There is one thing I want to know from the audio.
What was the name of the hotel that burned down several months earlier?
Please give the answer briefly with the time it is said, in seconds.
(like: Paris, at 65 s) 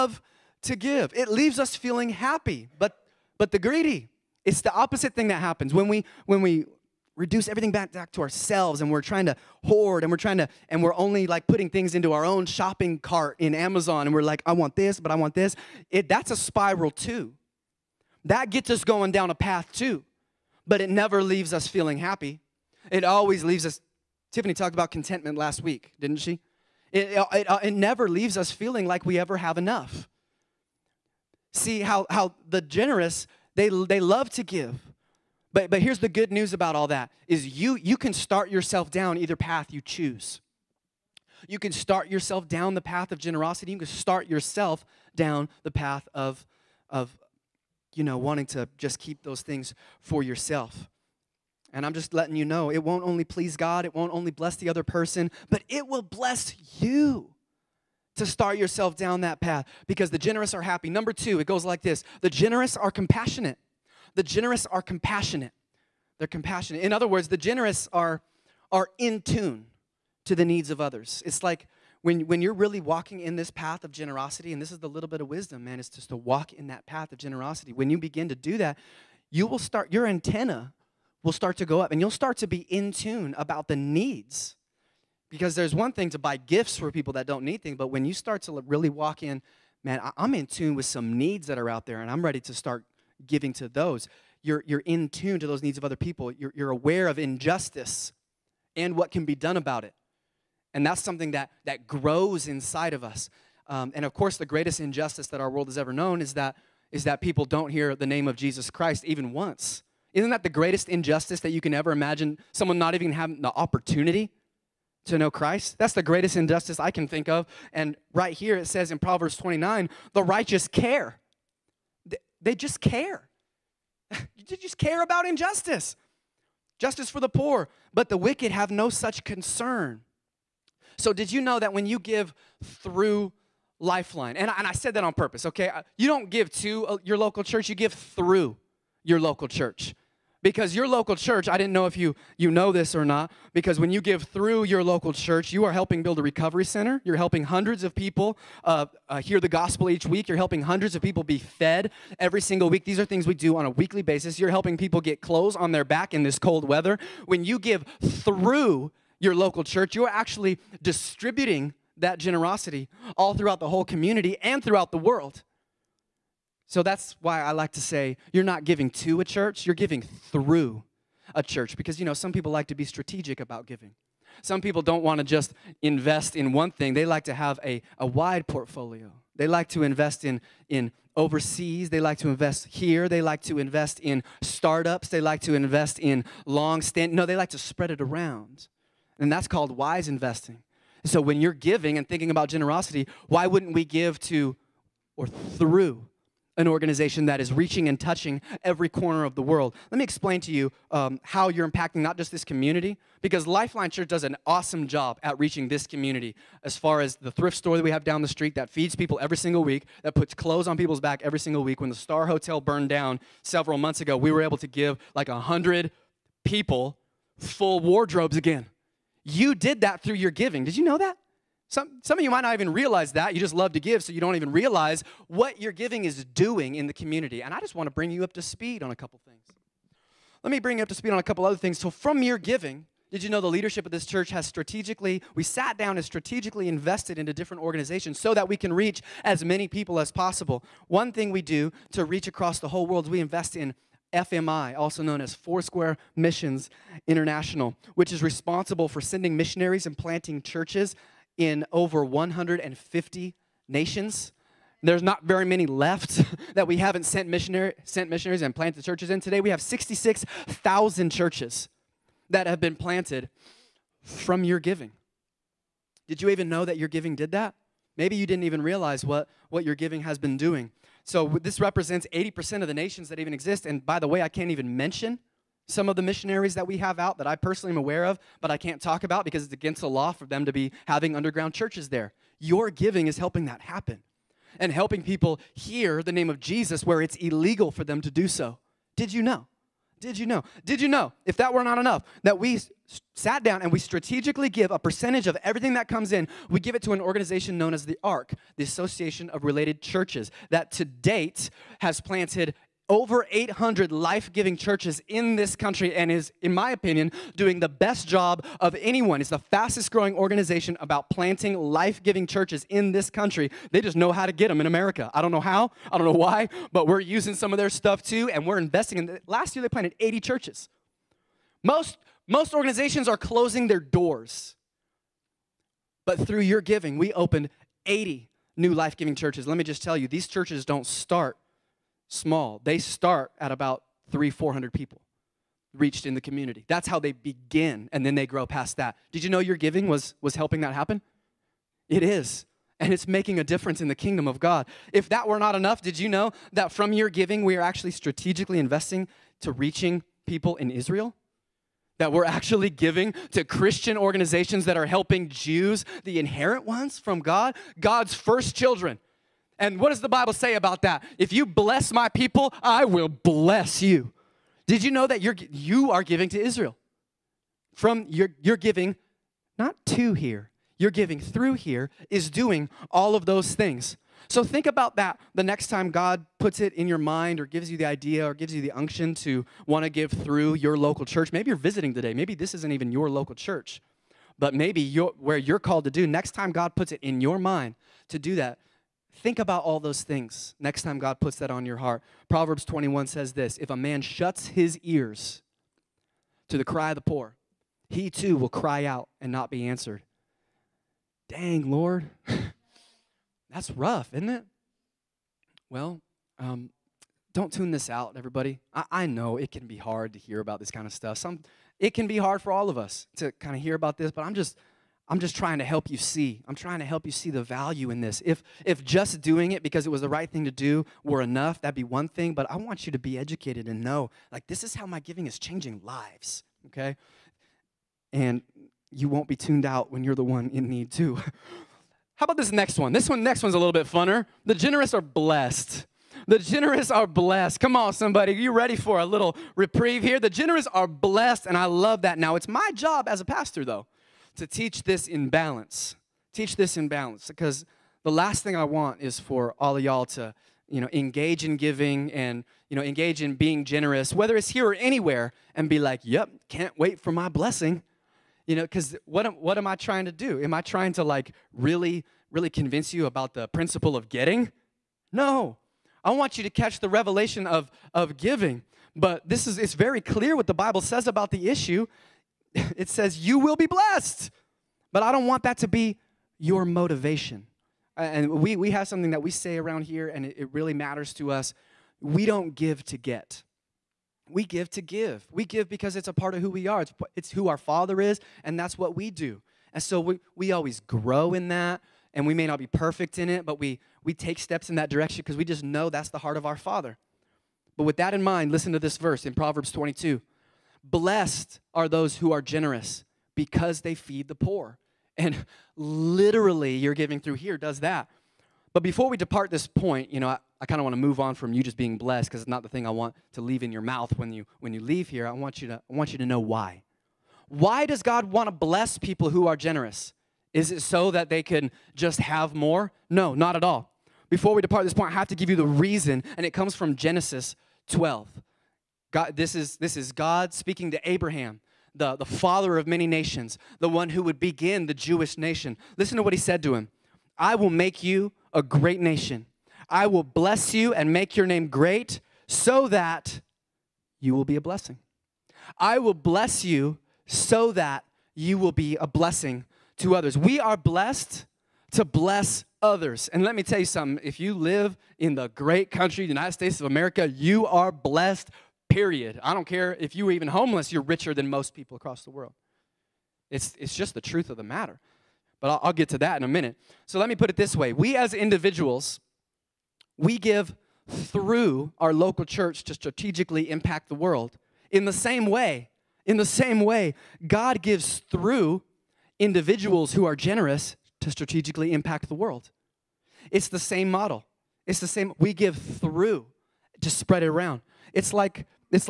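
Star Hotel, at 211 s.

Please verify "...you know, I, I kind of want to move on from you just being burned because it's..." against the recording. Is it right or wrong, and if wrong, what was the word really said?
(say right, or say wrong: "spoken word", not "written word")
wrong: "blessed", not "burned".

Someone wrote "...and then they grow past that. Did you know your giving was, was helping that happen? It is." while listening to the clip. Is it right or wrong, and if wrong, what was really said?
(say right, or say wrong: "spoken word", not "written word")
right.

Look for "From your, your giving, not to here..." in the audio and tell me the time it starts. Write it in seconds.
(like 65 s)
367 s.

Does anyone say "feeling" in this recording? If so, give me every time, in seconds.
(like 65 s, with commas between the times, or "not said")
1 s, 21 s, 28 s.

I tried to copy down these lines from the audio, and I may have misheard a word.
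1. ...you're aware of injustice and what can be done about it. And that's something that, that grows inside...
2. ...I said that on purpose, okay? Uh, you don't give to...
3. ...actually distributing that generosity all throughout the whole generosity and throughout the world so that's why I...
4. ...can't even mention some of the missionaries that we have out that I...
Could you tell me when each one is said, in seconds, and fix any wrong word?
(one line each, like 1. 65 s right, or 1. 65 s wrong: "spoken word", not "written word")
1. 96 s right
2. 134 s right
3. 160 s wrong: "community", not "generosity"
4. 274 s right.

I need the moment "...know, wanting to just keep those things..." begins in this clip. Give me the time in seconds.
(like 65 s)
48 s.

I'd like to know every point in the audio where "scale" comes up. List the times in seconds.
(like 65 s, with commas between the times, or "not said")
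not said.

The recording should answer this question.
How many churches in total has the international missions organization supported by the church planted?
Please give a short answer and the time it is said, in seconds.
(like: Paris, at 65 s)
66,000, at 259 s.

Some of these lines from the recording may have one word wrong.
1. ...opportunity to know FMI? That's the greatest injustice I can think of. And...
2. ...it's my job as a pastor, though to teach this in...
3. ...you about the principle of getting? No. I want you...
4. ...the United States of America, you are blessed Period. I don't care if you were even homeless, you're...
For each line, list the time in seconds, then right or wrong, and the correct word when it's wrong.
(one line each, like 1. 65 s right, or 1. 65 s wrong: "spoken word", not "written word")
1. 113 s wrong: "Christ", not "FMI"
2. 442 s right
3. 462 s right
4. 556 s right.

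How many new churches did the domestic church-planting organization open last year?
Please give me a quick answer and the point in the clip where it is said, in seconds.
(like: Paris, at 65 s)
80, at 319 s.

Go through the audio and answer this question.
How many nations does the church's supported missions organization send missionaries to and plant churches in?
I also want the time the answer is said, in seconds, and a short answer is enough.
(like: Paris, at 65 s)
over 150, at 251 s.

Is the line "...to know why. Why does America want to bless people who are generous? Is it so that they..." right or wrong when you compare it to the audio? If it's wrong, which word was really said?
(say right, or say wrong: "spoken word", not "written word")
wrong: "God", not "America".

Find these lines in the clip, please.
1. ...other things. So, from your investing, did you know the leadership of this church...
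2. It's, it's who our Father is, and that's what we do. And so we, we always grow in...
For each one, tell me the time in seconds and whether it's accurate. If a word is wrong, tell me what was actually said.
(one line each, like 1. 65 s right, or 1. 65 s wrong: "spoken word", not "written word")
1. 231 s wrong: "giving", not "investing"
2. 486 s right.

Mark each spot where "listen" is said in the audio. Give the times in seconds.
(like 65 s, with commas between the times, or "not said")
498 s, 535 s.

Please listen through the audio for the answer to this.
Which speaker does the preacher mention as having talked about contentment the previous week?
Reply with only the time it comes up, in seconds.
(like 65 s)
24 s.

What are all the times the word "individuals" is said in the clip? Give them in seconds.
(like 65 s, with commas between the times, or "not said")
568 s, 579 s.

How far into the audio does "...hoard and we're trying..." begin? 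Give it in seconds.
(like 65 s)
9 s.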